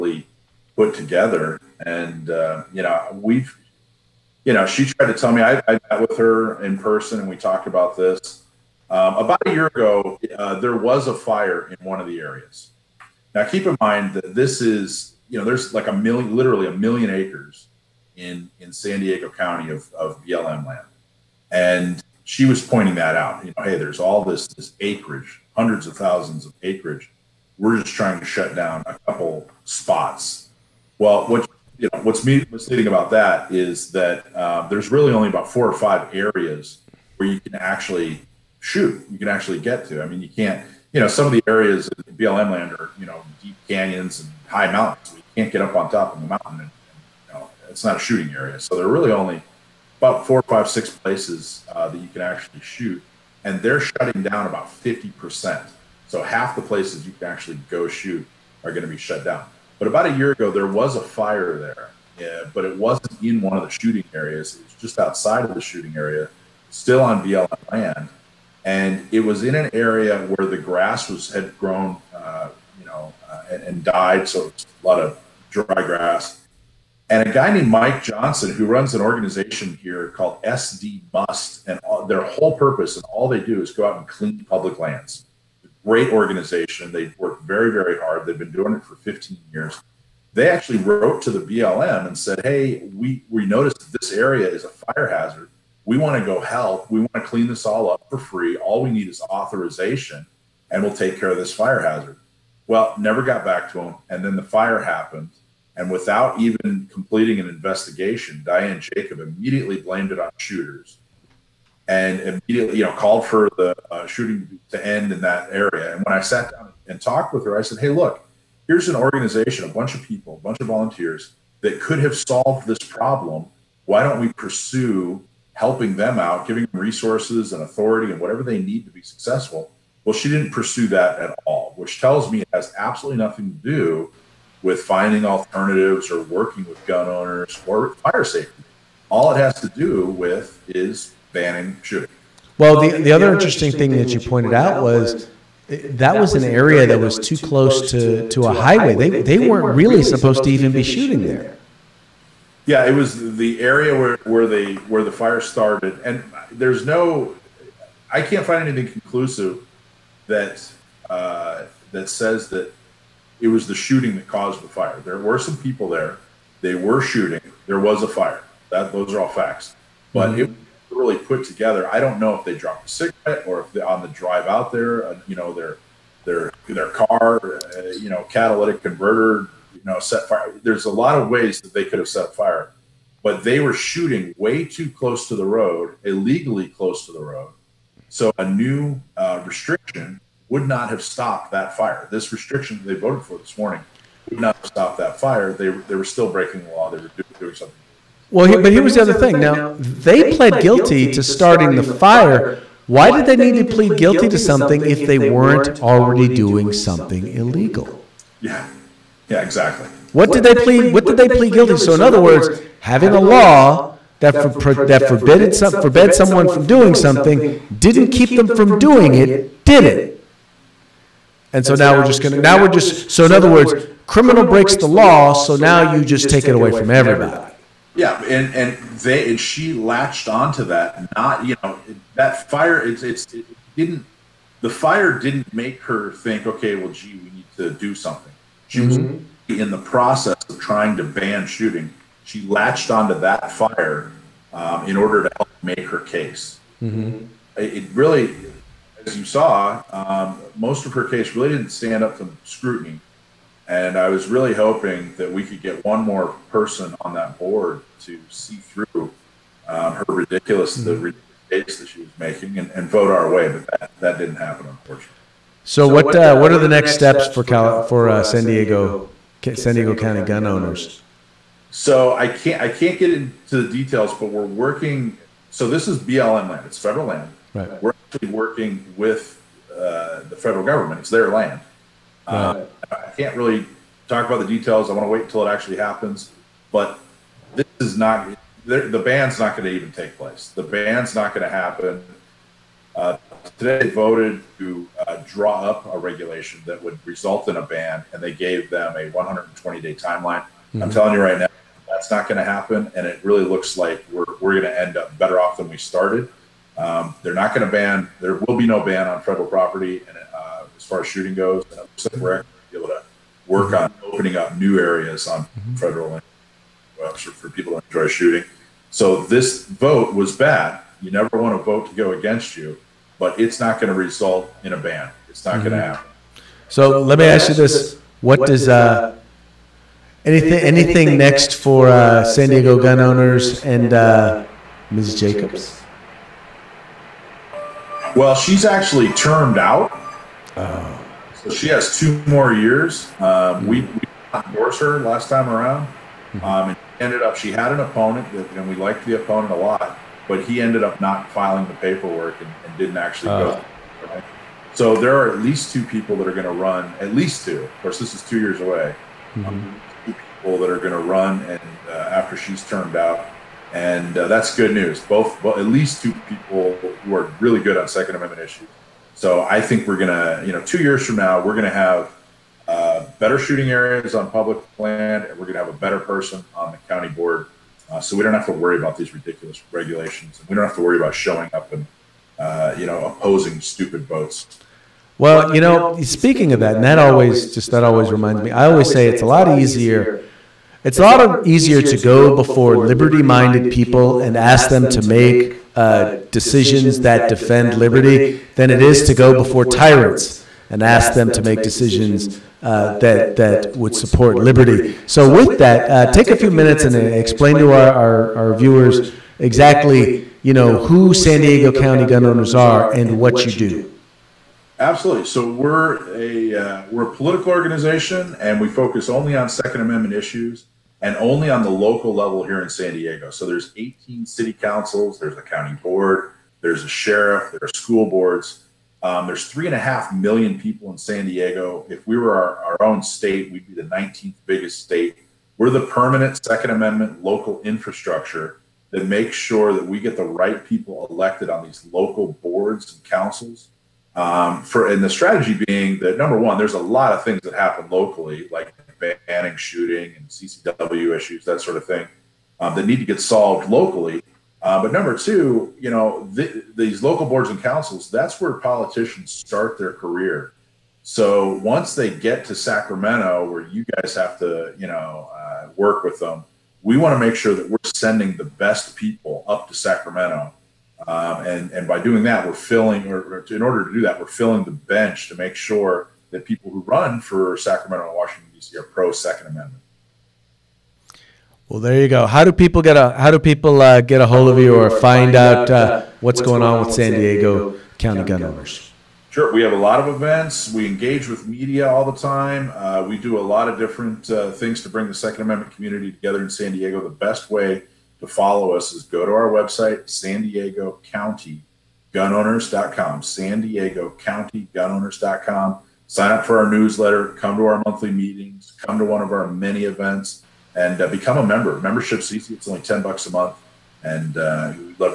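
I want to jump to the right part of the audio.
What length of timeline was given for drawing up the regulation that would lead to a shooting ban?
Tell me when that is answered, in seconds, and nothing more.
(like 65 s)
299 s.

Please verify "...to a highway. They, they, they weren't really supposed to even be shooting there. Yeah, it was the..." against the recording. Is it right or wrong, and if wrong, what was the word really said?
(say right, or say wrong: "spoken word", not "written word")
right.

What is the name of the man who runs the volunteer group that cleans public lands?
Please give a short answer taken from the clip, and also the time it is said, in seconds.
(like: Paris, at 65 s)
Mike Johnson, at 77 s.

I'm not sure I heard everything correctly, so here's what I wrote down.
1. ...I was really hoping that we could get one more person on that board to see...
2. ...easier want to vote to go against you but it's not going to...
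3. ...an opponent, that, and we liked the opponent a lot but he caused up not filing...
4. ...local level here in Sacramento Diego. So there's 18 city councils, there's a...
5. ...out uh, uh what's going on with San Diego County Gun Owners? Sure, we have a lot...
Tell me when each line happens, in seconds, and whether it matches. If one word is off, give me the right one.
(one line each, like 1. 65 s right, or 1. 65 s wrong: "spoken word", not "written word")
1. 253 s right
2. 321 s wrong: "never", not "easier"
3. 347 s wrong: "ended", not "caused"
4. 421 s wrong: "San", not "Sacramento"
5. 485 s right.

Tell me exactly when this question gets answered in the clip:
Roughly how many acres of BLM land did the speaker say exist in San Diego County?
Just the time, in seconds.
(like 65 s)
16 s.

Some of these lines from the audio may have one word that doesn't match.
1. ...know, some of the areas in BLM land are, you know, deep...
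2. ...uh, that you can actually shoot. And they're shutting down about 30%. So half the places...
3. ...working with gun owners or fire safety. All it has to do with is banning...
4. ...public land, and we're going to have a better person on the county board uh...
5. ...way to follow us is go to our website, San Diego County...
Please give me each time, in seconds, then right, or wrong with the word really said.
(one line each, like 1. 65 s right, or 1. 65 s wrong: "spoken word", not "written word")
1. 41 s right
2. 51 s wrong: "50", not "30"
3. 136 s right
4. 374 s right
5. 497 s right.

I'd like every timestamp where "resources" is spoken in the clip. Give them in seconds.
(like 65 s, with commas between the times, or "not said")
126 s.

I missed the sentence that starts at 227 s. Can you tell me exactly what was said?
Yeah, and, and they and she latched onto that.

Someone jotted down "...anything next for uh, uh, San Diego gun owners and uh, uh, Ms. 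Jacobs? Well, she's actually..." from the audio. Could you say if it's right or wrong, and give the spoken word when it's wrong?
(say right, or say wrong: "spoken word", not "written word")
right.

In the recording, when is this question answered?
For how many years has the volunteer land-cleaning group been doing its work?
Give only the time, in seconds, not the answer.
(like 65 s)
88 s.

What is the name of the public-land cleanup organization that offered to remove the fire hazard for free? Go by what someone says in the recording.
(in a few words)
SD Must.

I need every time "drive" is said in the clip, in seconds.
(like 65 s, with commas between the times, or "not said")
174 s.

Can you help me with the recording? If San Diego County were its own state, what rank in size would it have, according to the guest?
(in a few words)
19th.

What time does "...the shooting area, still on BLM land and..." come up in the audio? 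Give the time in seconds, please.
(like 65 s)
65 s.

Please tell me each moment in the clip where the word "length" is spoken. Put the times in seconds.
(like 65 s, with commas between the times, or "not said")
not said.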